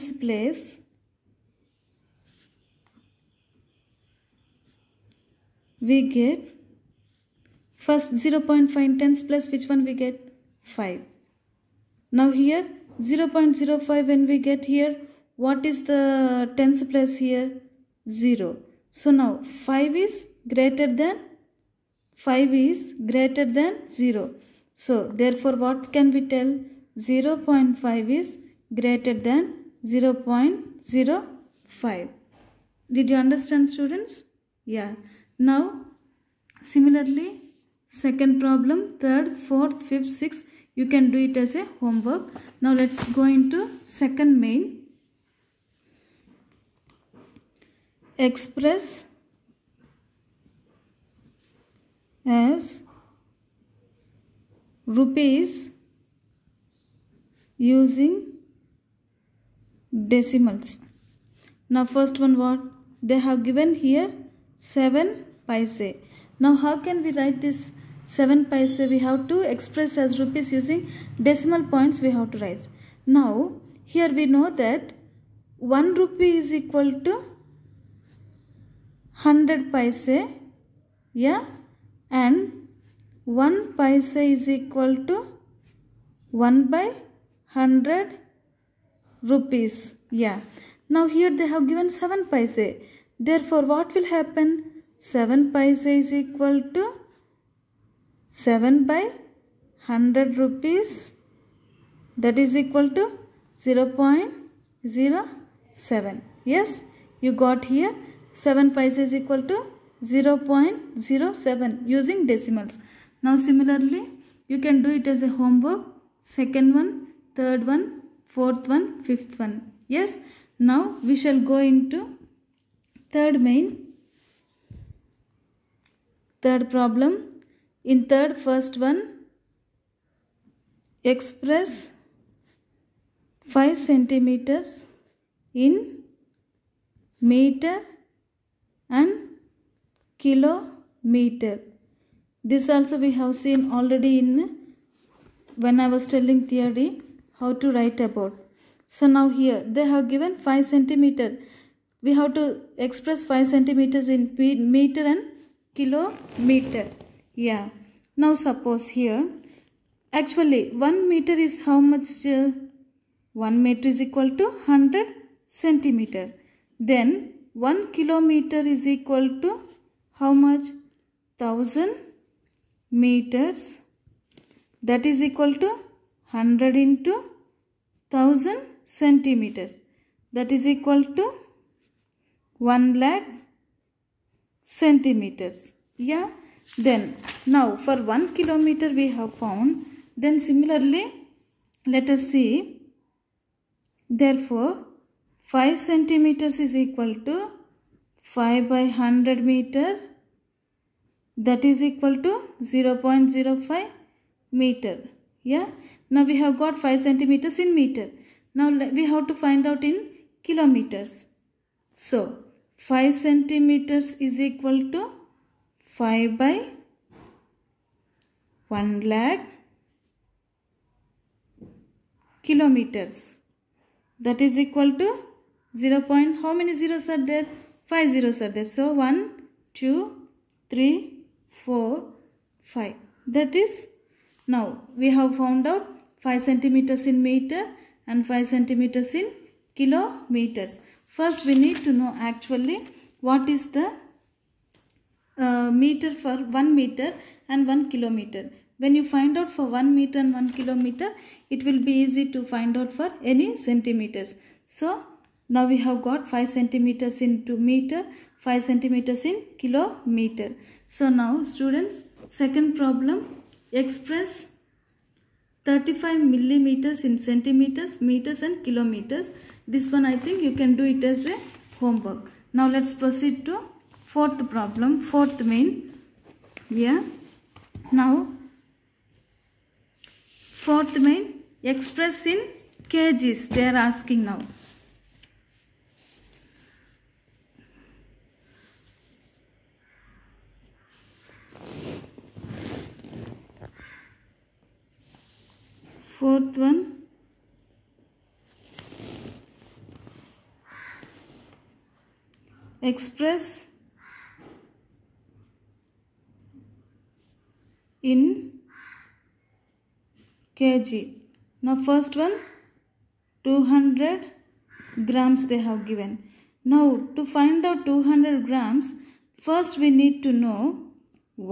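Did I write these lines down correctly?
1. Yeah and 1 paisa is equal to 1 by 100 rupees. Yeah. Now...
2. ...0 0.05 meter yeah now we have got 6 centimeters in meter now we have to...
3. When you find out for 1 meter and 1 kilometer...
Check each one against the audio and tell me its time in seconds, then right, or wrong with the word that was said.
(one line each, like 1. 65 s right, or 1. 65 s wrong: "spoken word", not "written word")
1. 81 s right
2. 202 s wrong: "5", not "6"
3. 248 s right.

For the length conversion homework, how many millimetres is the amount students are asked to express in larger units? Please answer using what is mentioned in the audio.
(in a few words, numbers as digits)
35.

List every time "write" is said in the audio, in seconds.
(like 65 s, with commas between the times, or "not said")
67 s, 72 s, 147 s.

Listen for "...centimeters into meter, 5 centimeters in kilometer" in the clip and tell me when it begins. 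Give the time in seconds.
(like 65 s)
256 s.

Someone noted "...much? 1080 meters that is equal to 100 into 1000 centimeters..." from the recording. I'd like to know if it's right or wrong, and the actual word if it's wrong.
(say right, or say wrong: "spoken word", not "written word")
wrong: "1000", not "1080".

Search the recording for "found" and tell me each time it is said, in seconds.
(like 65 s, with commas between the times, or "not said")
189 s, 235 s.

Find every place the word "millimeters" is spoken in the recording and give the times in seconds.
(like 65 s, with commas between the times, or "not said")
266 s.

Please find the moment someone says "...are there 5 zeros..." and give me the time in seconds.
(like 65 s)
227 s.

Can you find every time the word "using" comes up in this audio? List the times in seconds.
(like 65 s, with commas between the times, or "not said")
57 s, 70 s, 111 s.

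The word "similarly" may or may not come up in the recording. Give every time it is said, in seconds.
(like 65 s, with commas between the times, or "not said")
36 s, 113 s, 190 s.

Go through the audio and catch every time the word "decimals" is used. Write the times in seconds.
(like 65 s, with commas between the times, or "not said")
60 s, 71 s, 112 s.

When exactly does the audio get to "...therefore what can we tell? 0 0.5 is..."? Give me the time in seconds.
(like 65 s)
25 s.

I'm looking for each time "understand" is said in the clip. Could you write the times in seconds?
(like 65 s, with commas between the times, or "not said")
33 s.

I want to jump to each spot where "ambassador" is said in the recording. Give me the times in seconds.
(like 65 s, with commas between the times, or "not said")
not said.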